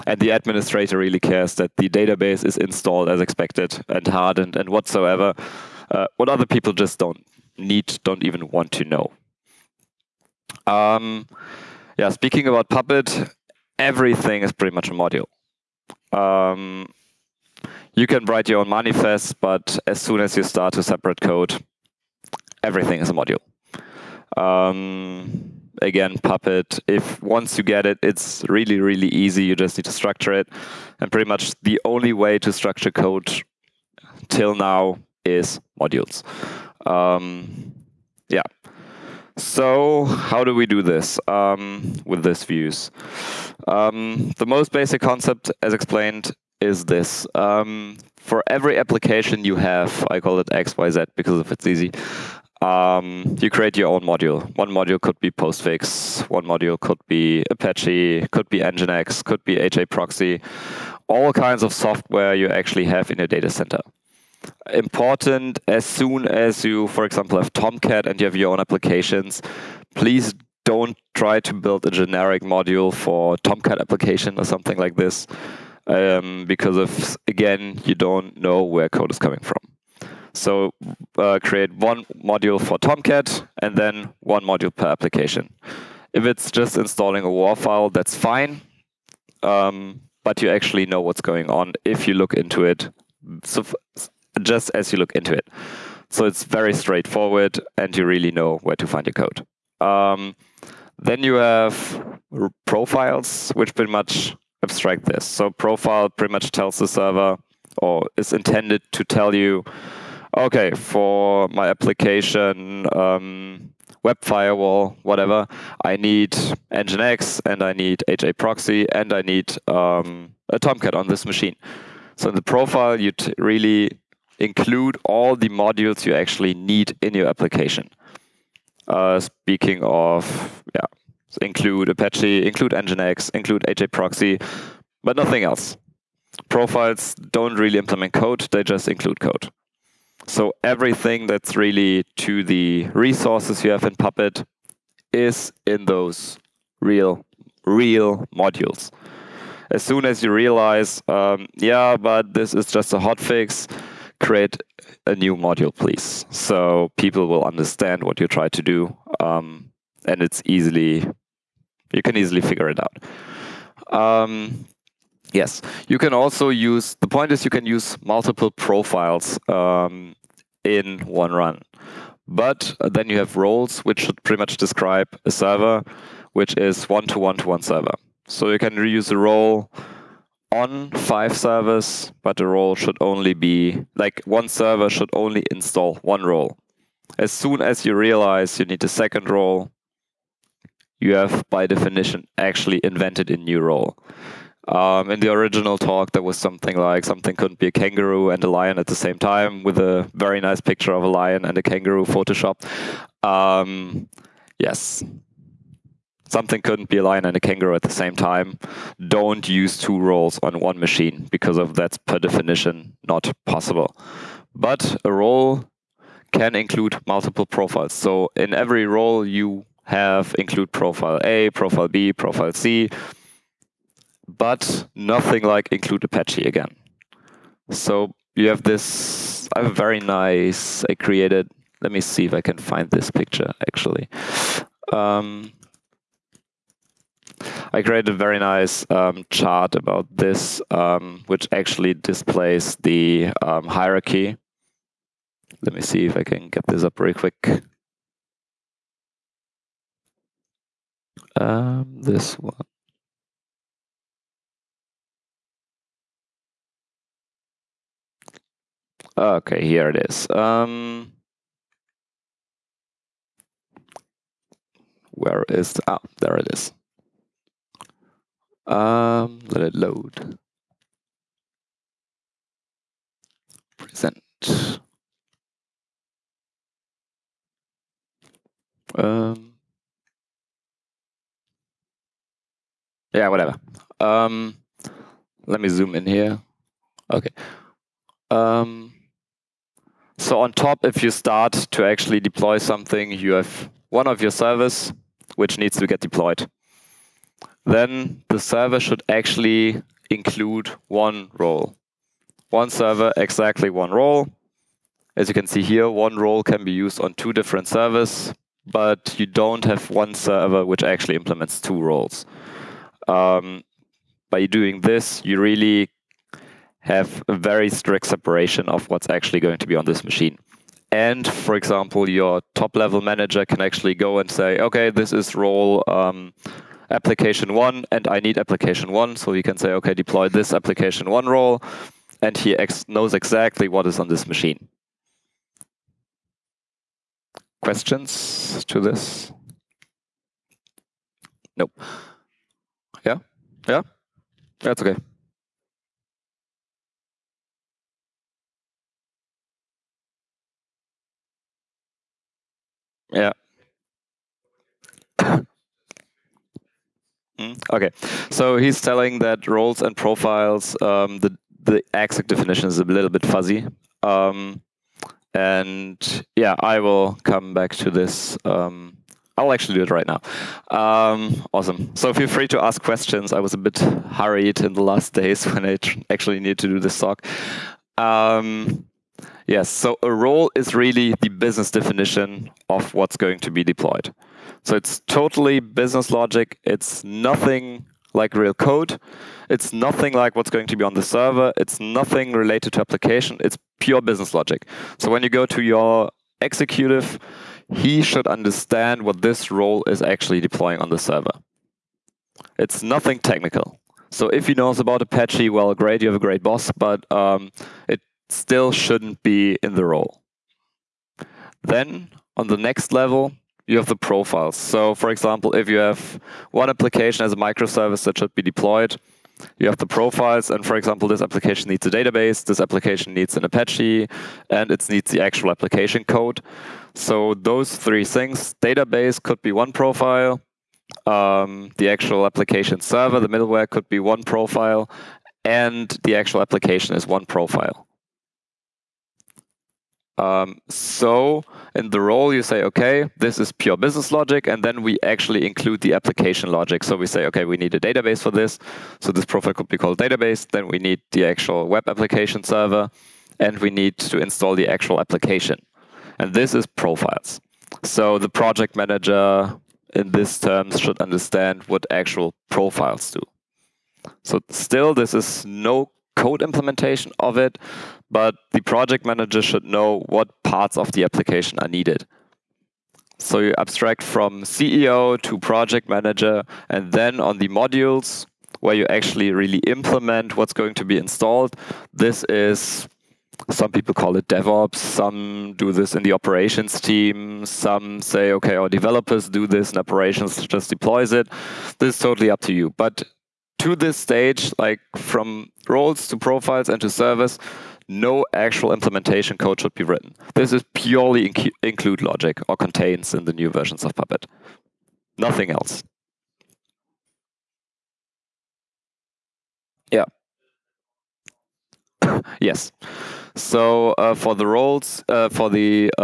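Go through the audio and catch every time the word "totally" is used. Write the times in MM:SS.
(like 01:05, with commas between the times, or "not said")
06:25, 08:12.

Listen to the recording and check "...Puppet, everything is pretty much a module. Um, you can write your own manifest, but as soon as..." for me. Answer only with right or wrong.
right.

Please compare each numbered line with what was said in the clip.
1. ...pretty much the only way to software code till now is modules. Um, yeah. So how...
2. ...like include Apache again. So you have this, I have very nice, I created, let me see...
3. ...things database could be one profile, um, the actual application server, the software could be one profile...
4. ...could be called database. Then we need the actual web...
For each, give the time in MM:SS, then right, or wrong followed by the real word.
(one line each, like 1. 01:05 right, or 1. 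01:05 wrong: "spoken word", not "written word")
1. 00:31 wrong: "structure", not "software"
2. 03:45 right
3. 07:08 wrong: "middleware", not "software"
4. 07:29 right.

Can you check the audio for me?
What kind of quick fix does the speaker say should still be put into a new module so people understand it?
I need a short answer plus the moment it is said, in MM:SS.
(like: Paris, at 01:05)
hotfix, at 02:32.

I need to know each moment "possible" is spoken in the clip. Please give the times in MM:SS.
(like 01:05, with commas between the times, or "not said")
03:33.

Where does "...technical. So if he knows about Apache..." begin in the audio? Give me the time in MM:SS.
06:43.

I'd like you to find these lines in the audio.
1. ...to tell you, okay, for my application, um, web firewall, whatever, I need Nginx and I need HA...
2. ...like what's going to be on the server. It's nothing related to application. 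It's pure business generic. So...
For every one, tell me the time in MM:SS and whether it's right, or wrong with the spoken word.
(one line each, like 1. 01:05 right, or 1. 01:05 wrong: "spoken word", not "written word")
1. 01:48 right
2. 06:30 wrong: "logic", not "generic".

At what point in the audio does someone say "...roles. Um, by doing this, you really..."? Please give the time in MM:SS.
05:11.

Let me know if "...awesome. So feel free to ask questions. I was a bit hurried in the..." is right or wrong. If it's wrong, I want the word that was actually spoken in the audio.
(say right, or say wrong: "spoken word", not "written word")
right.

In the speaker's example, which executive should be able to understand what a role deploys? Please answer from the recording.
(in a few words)
CEO.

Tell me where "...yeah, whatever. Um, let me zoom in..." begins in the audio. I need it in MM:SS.
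04:43.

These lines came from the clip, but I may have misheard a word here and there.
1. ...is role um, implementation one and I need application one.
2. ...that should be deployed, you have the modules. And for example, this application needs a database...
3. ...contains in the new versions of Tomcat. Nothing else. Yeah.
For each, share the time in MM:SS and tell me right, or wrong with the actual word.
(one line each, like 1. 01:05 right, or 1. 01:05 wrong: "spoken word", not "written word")
1. 05:25 wrong: "application", not "implementation"
2. 06:58 wrong: "profiles", not "modules"
3. 08:22 wrong: "Puppet", not "Tomcat".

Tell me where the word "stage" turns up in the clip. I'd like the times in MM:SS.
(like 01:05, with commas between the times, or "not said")
08:13.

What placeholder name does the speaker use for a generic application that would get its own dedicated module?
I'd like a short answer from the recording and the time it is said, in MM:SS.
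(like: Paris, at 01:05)
XYZ, at 00:50.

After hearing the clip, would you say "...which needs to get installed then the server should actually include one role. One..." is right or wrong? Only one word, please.
wrong.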